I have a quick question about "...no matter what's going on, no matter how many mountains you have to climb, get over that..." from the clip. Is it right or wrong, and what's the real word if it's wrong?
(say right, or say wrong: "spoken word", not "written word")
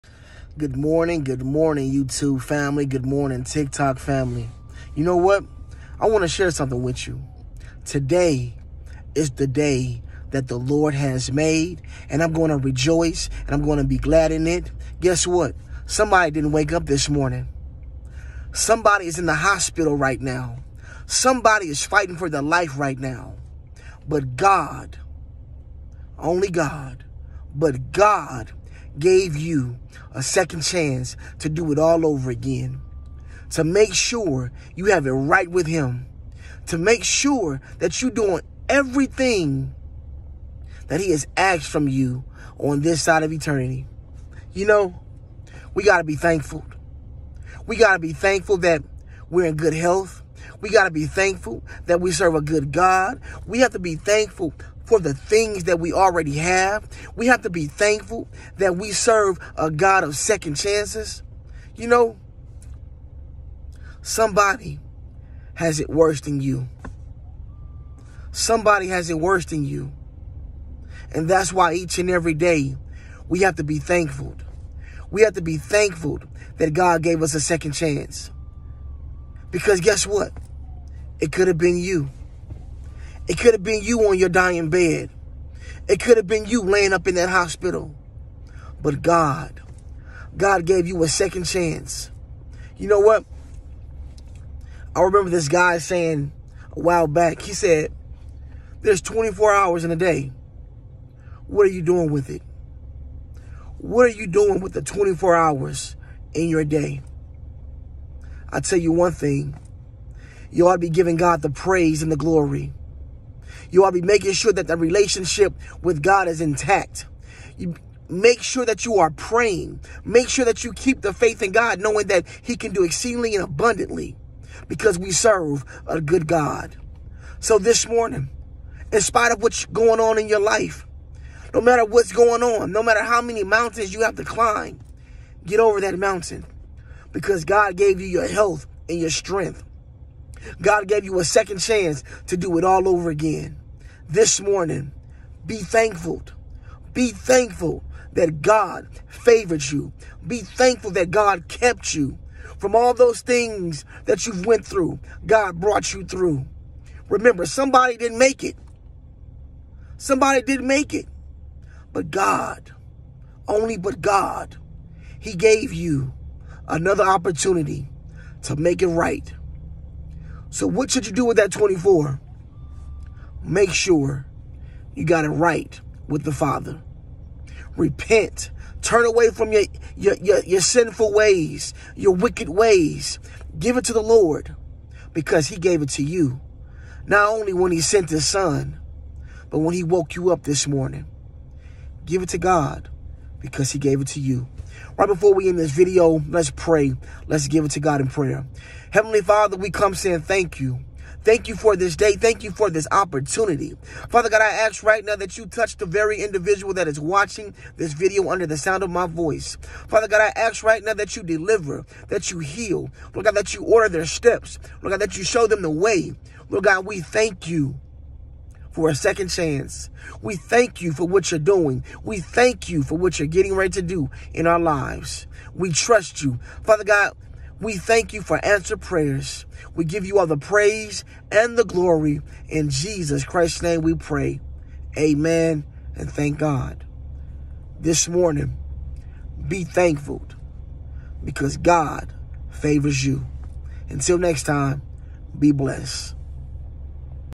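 right.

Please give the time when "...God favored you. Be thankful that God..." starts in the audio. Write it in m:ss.
2:28.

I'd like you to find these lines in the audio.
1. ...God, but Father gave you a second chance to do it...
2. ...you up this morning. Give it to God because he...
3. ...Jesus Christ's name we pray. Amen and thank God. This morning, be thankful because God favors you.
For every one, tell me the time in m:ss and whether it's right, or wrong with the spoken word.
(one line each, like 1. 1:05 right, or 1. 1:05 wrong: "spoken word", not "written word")
1. 0:26 wrong: "God", not "Father"
2. 3:10 right
3. 3:52 right.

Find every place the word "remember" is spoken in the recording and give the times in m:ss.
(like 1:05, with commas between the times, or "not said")
1:35, 2:37.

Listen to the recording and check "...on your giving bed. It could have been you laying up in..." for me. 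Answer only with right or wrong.
wrong.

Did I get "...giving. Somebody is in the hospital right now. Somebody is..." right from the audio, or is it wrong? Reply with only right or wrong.
wrong.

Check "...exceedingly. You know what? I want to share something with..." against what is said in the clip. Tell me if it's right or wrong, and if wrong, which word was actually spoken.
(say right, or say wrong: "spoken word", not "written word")
wrong: "family", not "exceedingly".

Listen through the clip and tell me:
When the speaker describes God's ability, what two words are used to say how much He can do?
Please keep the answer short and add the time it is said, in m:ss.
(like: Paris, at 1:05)
exceedingly and abundantly, at 2:02.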